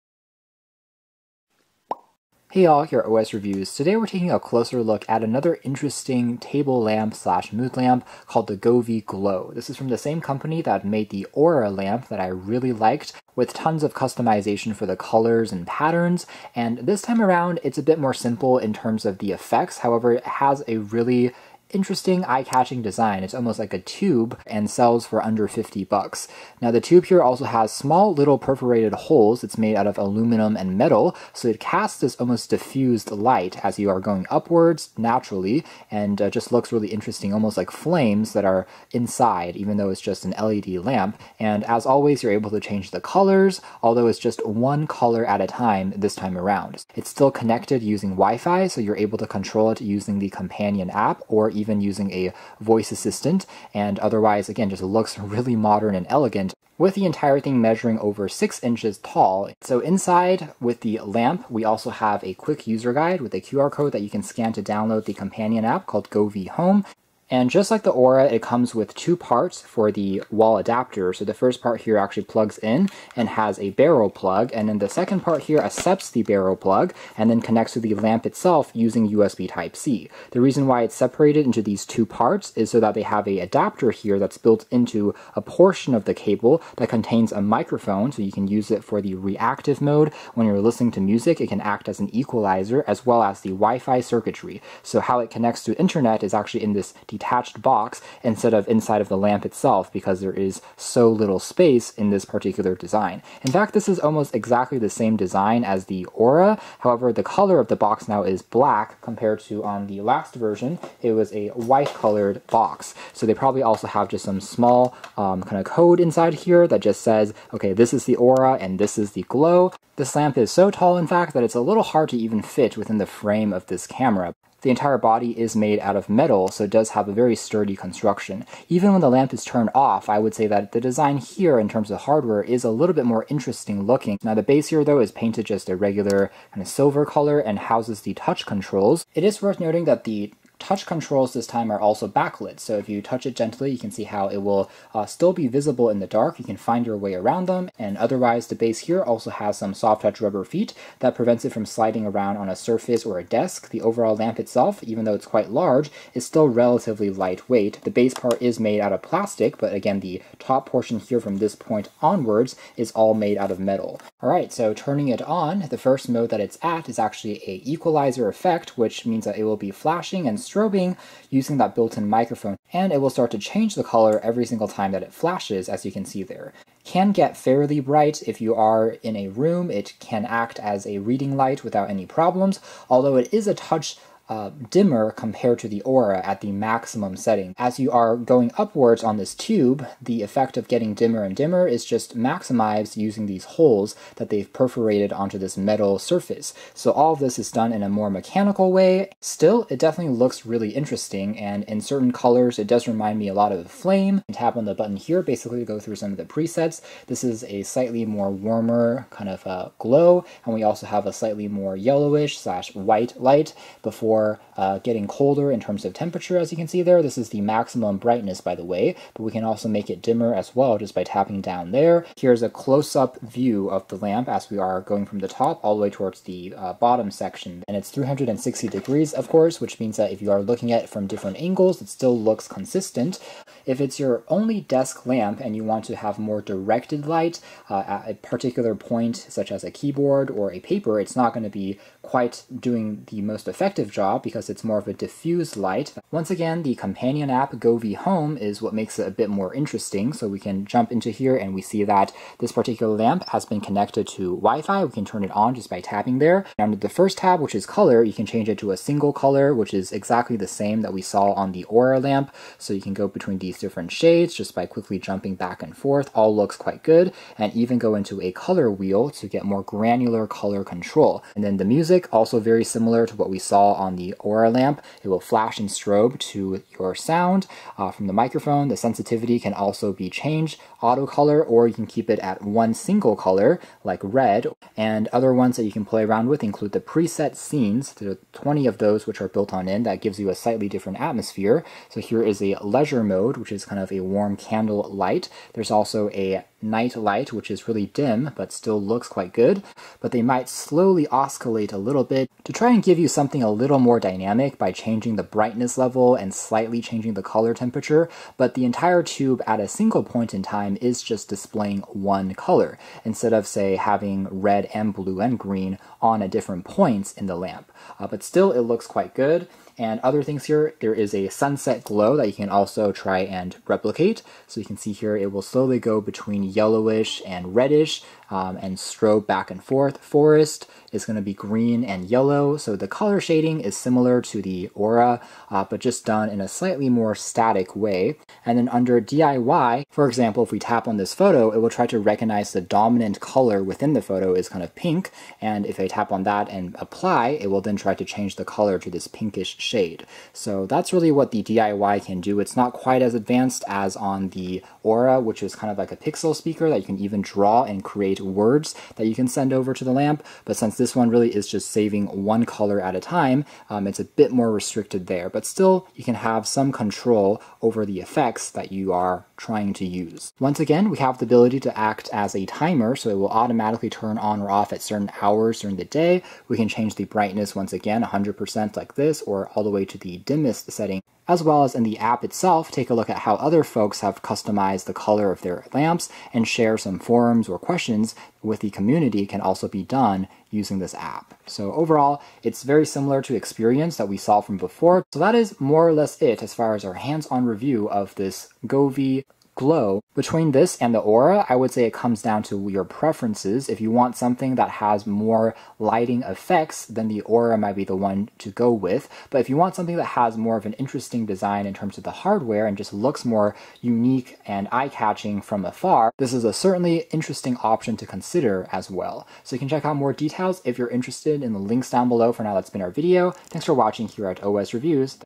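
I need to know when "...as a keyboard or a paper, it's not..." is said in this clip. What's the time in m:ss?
3:59.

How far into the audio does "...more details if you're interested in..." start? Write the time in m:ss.
6:59.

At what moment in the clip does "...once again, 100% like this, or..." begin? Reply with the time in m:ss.
6:17.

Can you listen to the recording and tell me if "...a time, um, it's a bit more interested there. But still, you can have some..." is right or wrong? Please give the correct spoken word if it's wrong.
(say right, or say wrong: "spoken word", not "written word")
wrong: "restricted", not "interested".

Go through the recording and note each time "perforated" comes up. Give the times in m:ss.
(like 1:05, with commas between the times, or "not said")
0:28, 3:14.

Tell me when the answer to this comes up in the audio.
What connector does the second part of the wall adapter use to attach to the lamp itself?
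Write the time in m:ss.
1:19.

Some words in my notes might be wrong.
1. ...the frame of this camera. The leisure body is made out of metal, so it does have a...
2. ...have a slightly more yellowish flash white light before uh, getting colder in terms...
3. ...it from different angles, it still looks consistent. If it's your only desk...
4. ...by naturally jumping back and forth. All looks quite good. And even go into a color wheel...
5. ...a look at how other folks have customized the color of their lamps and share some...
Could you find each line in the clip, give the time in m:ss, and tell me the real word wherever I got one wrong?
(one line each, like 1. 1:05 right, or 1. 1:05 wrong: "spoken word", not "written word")
1. 2:02 wrong: "entire", not "leisure"
2. 3:30 wrong: "slash", not "flash"
3. 3:50 right
4. 4:24 wrong: "quickly", not "naturally"
5. 6:22 right.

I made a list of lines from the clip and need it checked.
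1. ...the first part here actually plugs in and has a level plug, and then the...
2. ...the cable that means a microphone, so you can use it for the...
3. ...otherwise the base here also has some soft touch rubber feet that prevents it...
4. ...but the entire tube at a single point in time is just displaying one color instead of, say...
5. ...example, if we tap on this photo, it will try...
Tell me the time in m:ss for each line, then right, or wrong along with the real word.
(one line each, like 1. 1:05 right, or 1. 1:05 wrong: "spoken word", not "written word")
1. 1:11 wrong: "barrel", not "level"
2. 1:26 wrong: "contains", not "means"
3. 2:27 right
4. 5:08 right
5. 5:40 right.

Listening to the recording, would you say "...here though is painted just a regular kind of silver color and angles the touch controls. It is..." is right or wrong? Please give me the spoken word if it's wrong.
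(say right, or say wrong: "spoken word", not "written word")
wrong: "houses", not "angles".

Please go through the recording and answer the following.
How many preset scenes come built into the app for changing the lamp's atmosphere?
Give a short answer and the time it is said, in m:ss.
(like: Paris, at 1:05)
20, at 4:48.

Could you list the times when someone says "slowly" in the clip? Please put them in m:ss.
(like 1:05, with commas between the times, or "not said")
5:00, 5:25.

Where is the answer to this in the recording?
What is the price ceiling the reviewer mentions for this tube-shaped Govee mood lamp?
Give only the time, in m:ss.
0:25.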